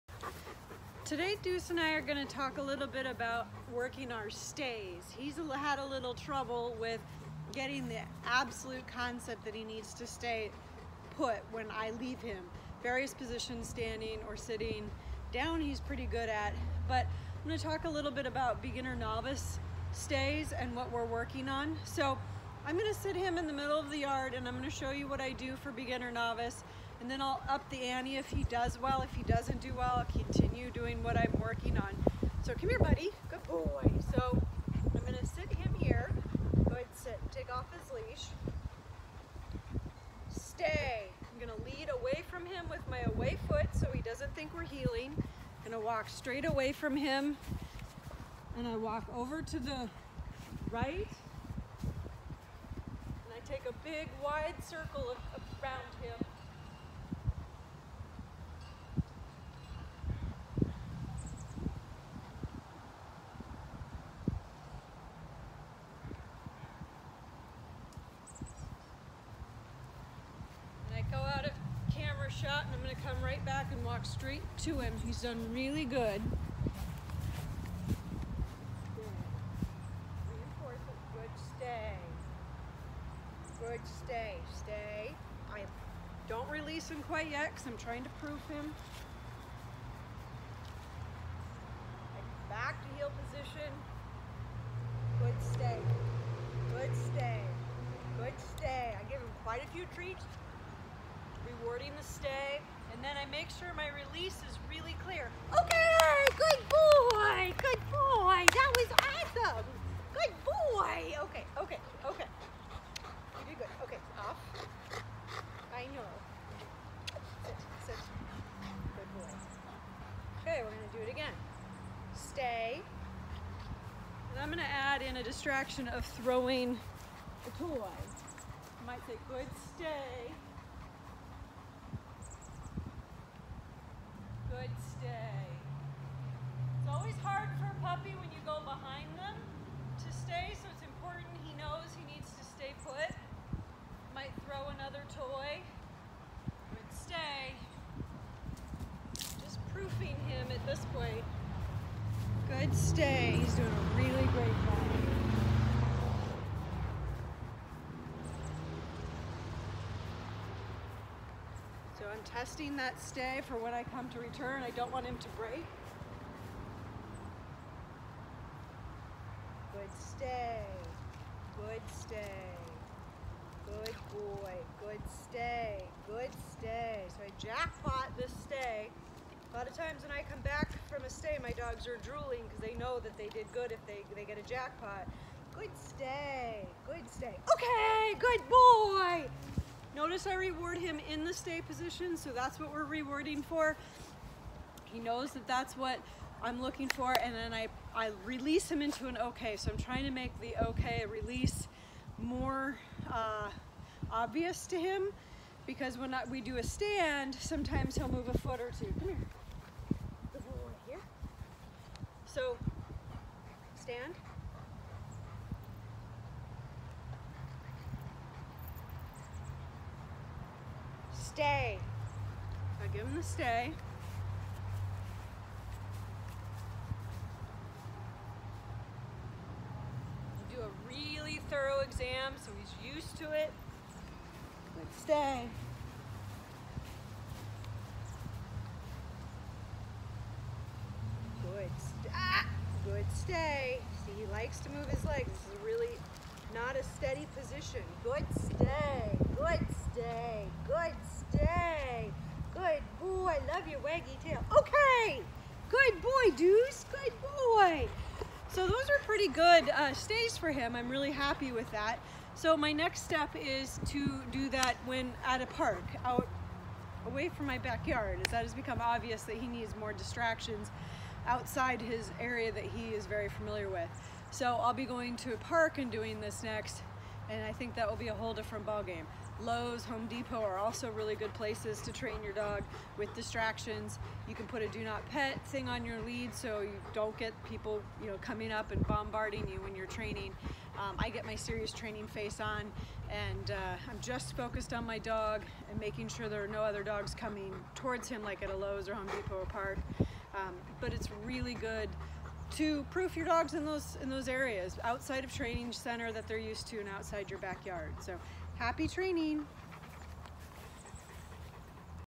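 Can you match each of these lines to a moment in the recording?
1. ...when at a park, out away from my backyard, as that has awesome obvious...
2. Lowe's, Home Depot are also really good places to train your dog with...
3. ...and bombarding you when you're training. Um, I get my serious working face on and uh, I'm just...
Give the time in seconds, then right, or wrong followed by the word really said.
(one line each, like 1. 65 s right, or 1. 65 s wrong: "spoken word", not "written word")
1. 264 s wrong: "become", not "awesome"
2. 279 s right
3. 288 s wrong: "training", not "working".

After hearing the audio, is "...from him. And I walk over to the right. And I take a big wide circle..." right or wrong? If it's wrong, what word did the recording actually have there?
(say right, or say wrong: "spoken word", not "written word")
right.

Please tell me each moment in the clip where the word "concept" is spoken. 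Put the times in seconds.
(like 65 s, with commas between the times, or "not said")
8 s.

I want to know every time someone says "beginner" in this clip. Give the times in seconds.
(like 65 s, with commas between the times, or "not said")
18 s, 25 s.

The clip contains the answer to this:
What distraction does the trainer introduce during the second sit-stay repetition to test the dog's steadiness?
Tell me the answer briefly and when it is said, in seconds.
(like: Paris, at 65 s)
Throwing a toy, at 126 s.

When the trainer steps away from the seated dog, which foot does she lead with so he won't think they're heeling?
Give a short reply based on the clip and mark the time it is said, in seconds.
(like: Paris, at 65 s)
Away foot, at 43 s.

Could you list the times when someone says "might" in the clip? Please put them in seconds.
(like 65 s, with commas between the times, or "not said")
128 s, 144 s.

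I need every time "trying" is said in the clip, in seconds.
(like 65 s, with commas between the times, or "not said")
87 s, 199 s.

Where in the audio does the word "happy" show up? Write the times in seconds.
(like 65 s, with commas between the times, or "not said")
261 s, 308 s.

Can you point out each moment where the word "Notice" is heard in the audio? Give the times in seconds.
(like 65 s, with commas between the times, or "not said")
189 s.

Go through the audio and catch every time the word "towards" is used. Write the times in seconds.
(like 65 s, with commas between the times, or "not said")
297 s.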